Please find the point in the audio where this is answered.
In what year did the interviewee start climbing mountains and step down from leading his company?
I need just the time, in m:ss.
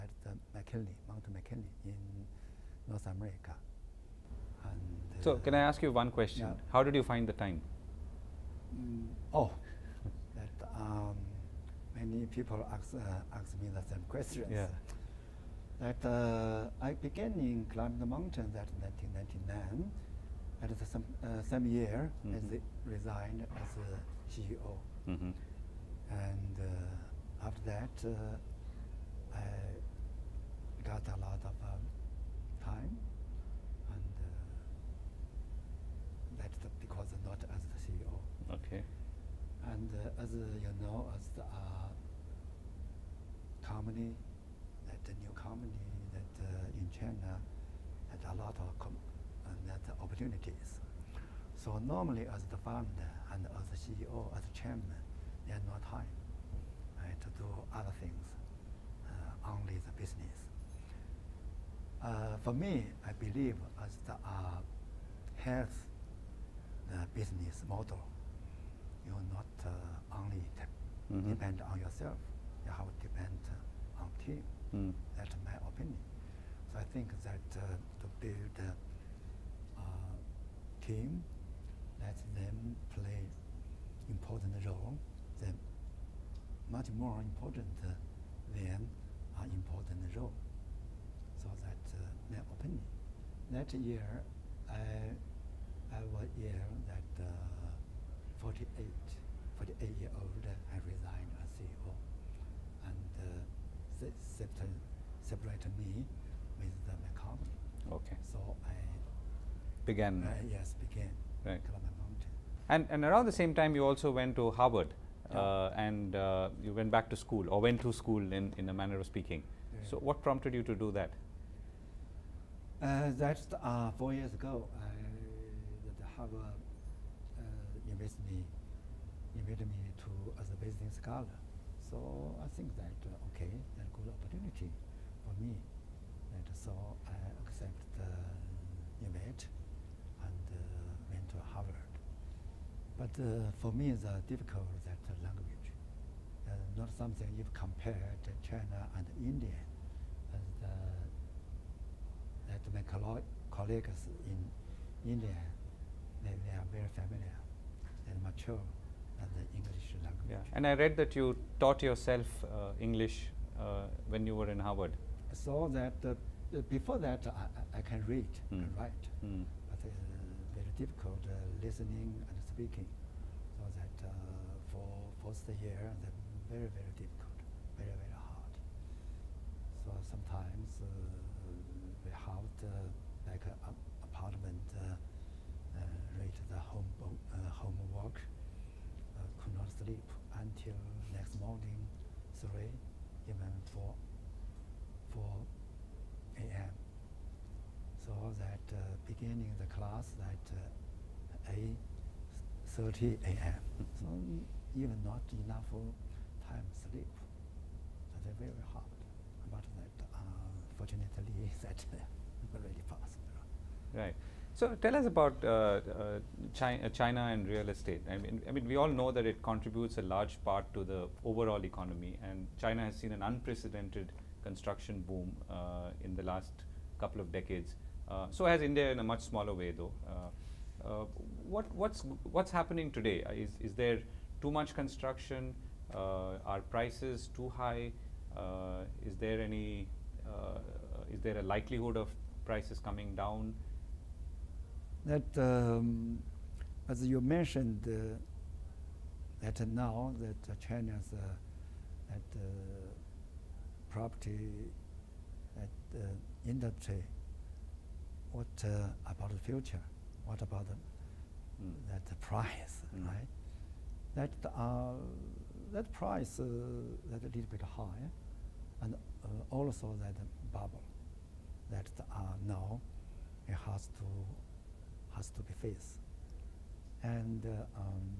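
0:18.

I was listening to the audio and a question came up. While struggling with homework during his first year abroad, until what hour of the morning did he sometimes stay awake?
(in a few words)
4 a.m.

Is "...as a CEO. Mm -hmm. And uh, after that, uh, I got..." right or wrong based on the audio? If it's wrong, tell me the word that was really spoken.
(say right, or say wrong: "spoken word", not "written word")
right.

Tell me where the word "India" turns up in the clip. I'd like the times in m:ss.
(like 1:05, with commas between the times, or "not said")
2:29, 2:35, 3:48.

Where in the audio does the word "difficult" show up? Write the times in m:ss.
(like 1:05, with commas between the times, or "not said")
2:24, 2:50, 2:56.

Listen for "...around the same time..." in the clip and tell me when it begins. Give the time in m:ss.
1:53.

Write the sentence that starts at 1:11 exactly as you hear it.
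depend on yourself, you have to depend on team.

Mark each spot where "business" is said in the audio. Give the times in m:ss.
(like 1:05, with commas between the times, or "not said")
1:00, 1:07.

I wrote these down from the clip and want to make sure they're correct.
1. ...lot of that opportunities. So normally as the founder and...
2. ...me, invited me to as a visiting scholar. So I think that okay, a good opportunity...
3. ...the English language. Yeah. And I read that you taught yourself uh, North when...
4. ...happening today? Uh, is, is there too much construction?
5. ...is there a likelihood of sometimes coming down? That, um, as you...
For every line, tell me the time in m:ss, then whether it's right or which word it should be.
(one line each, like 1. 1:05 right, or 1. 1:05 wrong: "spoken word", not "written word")
1. 0:48 right
2. 2:08 right
3. 2:39 wrong: "English", not "North"
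4. 3:52 right
5. 4:01 wrong: "prices", not "sometimes".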